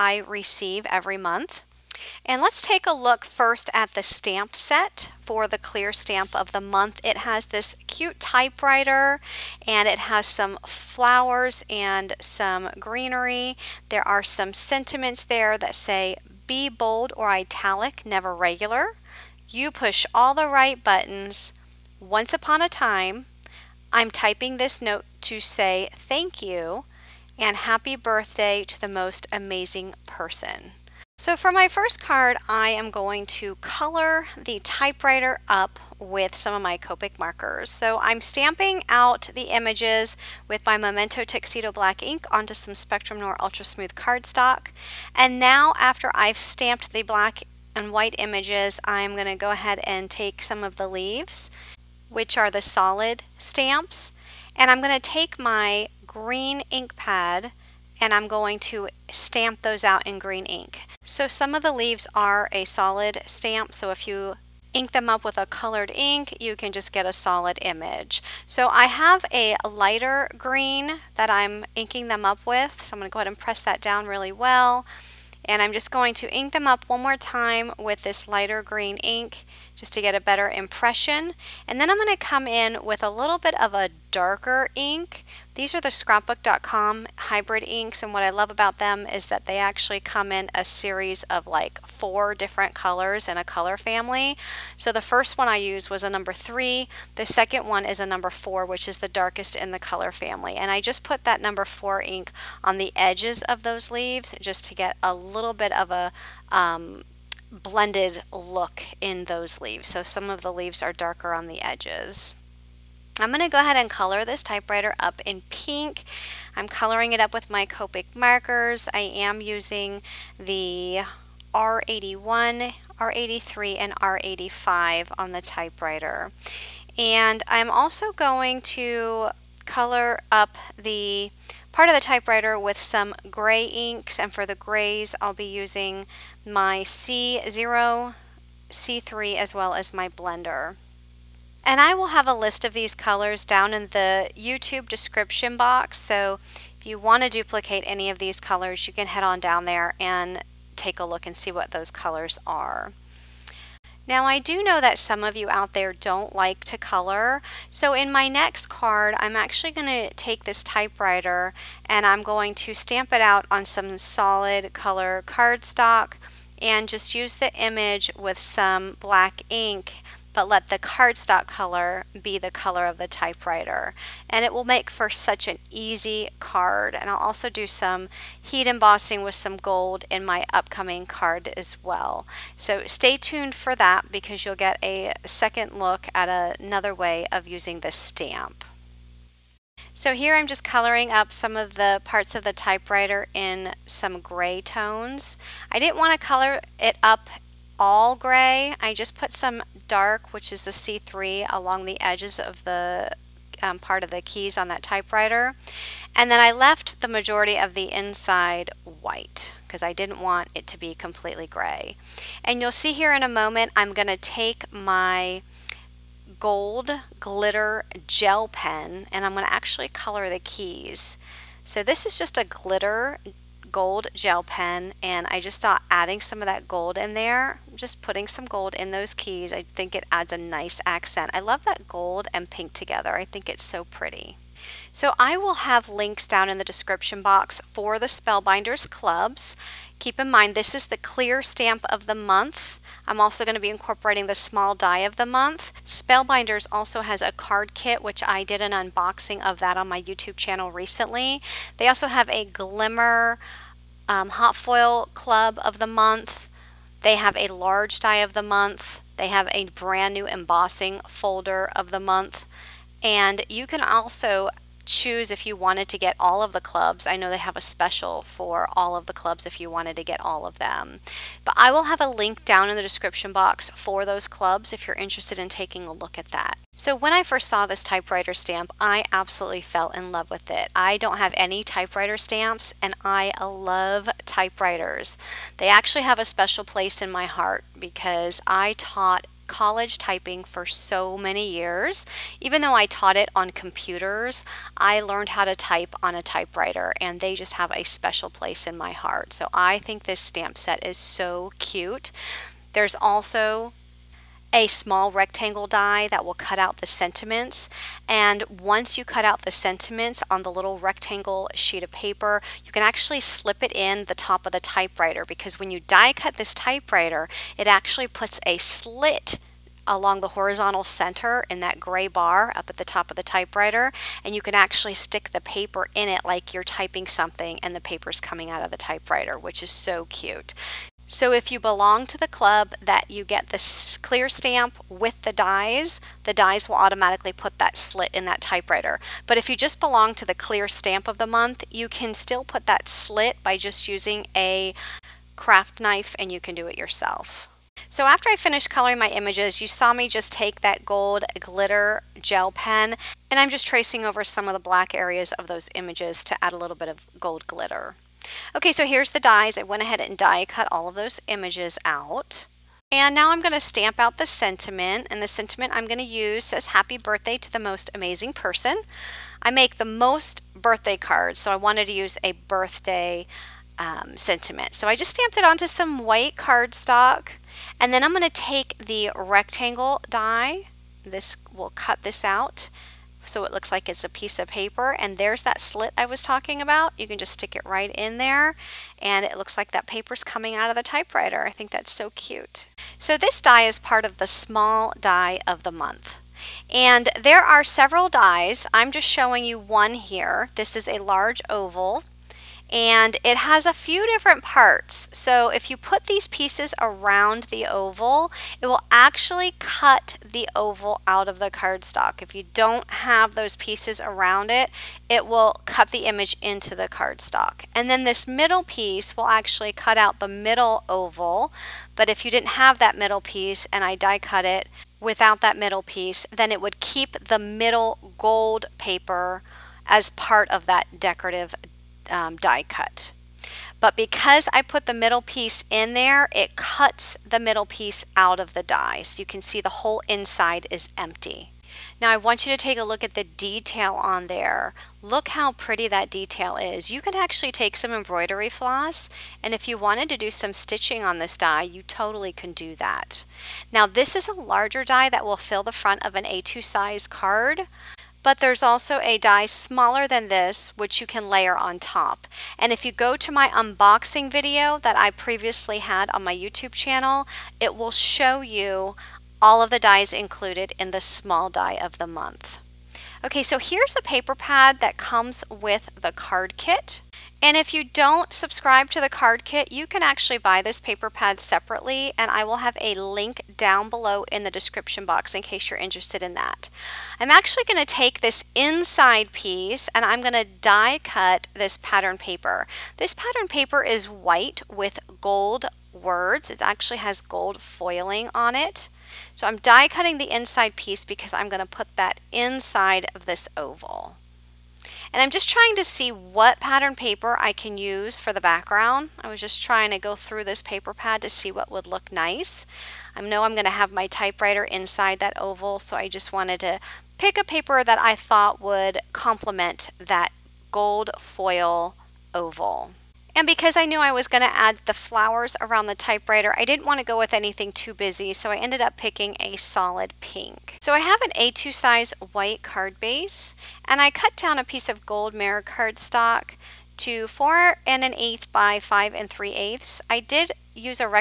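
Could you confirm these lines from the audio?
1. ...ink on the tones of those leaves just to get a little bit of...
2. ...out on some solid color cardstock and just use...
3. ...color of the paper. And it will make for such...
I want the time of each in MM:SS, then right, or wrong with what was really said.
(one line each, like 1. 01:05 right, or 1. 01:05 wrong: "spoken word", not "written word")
1. 01:41 wrong: "edges", not "tones"
2. 02:43 right
3. 02:52 wrong: "typewriter", not "paper".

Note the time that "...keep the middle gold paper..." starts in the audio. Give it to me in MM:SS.
07:06.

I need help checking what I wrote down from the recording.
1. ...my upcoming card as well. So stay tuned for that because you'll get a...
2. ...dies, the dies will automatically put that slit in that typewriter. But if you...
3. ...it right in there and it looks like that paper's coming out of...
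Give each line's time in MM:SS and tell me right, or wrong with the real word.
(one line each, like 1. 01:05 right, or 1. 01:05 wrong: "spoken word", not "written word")
1. 03:00 right
2. 05:35 right
3. 06:27 right.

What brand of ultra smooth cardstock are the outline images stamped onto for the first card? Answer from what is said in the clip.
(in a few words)
Spectrum Noir.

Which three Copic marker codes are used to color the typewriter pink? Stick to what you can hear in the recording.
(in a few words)
R81, R83, R85.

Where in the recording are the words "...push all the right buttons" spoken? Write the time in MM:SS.
00:19.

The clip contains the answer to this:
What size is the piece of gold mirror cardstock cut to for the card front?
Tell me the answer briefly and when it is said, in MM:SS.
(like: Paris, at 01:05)
4 1/8 by 5 3/8, at 08:57.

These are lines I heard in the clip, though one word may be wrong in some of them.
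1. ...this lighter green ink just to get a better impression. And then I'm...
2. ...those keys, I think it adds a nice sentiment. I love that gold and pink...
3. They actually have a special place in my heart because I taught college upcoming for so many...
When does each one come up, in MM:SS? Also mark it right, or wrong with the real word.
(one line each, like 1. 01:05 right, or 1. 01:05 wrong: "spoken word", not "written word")
1. 01:18 right
2. 03:48 wrong: "accent", not "sentiment"
3. 04:45 wrong: "typing", not "upcoming".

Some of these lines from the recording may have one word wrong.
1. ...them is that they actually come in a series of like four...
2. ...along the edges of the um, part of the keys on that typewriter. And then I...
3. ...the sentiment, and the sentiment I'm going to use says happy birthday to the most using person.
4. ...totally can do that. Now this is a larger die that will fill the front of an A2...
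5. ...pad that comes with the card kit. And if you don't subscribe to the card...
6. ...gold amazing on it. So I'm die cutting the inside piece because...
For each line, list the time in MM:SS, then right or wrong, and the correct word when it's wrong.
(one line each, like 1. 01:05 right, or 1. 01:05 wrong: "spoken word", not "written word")
1. 01:28 right
2. 03:21 right
3. 06:04 wrong: "amazing", not "using"
4. 07:31 right
5. 07:54 right
6. 08:17 wrong: "foiling", not "amazing".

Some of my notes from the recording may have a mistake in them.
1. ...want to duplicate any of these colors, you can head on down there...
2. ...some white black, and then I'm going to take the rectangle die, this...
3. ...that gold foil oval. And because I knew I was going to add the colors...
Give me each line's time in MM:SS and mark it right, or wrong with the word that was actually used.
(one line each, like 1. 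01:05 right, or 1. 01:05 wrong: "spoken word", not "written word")
1. 02:26 right
2. 06:15 wrong: "cardstock", not "black"
3. 08:39 wrong: "flowers", not "colors".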